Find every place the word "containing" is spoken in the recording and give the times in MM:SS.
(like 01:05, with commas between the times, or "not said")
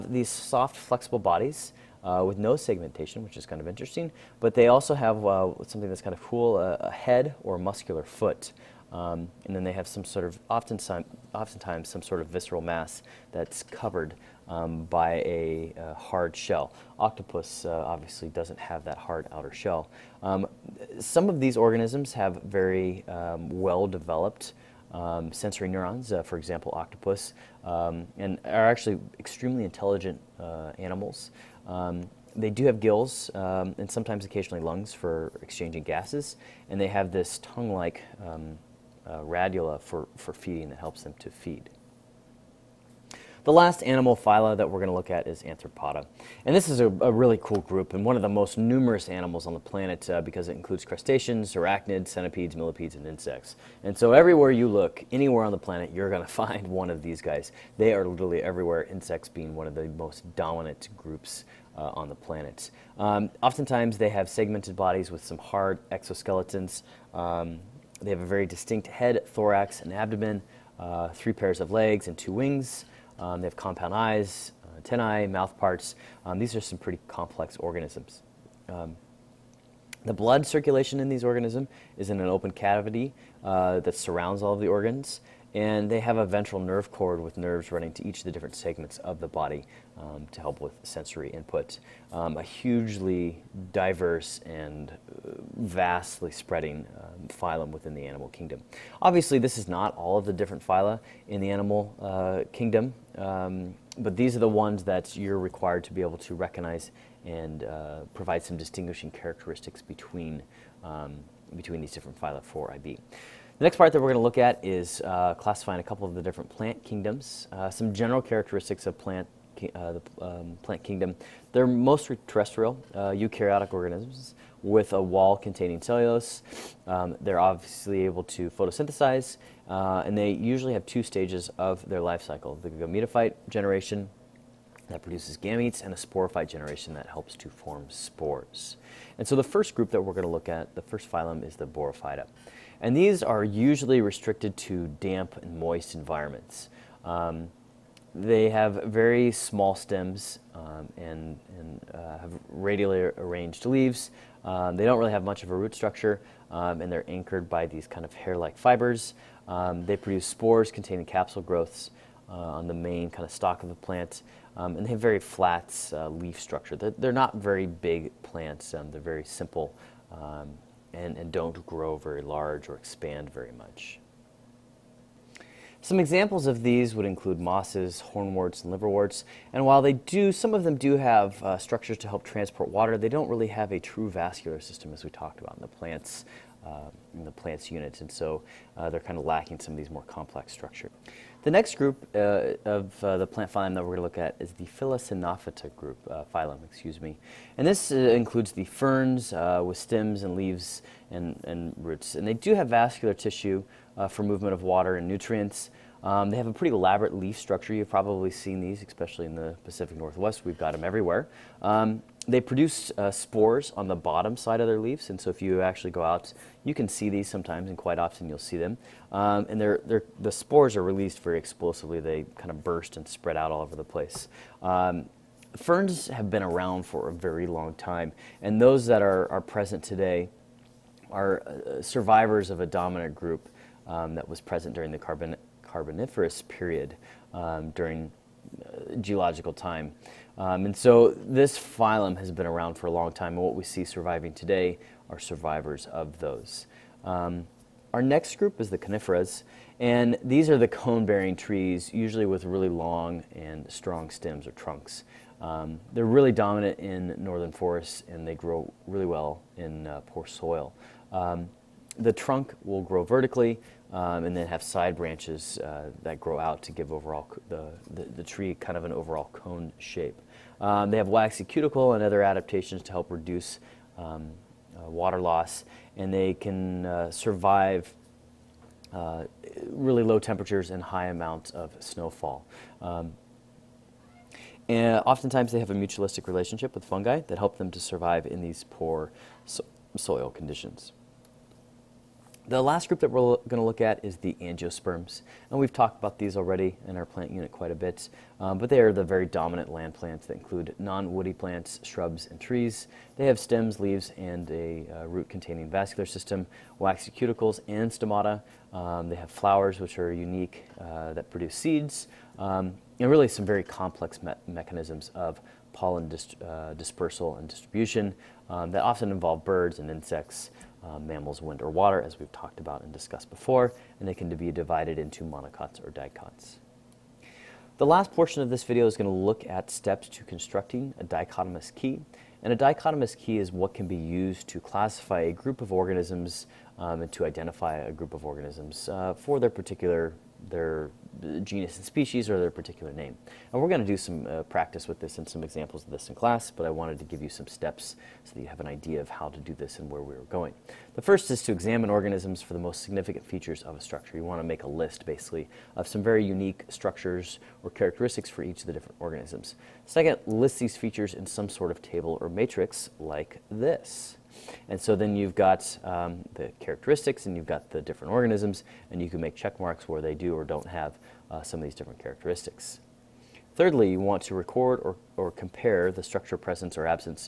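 02:05, 02:40, 05:05.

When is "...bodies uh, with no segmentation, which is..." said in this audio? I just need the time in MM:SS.
00:01.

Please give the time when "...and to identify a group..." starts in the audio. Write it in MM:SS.
05:37.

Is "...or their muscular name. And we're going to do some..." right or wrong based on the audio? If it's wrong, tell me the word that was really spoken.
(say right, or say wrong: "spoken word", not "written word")
wrong: "particular", not "muscular".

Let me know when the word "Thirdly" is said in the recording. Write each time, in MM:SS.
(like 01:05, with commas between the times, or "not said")
06:13.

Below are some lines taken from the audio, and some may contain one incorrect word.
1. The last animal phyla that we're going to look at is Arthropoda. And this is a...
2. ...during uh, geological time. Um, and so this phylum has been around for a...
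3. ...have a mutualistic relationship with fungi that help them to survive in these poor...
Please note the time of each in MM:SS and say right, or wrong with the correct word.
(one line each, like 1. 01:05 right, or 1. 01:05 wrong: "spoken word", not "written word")
1. 00:43 right
2. 03:57 right
3. 04:45 right.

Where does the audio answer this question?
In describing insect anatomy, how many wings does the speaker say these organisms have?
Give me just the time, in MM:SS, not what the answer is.
01:12.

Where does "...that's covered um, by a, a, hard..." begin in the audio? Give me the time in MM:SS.
00:13.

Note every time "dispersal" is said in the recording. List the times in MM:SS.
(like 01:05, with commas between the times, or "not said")
05:16.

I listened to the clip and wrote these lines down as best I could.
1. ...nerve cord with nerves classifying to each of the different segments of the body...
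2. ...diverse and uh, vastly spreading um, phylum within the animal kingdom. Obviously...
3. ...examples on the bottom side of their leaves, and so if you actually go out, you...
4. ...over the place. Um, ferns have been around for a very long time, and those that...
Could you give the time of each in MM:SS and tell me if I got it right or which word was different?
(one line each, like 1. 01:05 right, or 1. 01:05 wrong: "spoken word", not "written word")
1. 01:26 wrong: "running", not "classifying"
2. 01:33 right
3. 03:33 wrong: "spores", not "examples"
4. 03:43 right.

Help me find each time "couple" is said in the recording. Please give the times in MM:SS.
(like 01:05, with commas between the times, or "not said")
01:55.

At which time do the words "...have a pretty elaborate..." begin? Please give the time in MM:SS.
03:26.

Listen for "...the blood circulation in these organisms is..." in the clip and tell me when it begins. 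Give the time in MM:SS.
01:20.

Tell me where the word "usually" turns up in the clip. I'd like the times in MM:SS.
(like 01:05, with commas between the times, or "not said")
02:10, 02:23, 04:11.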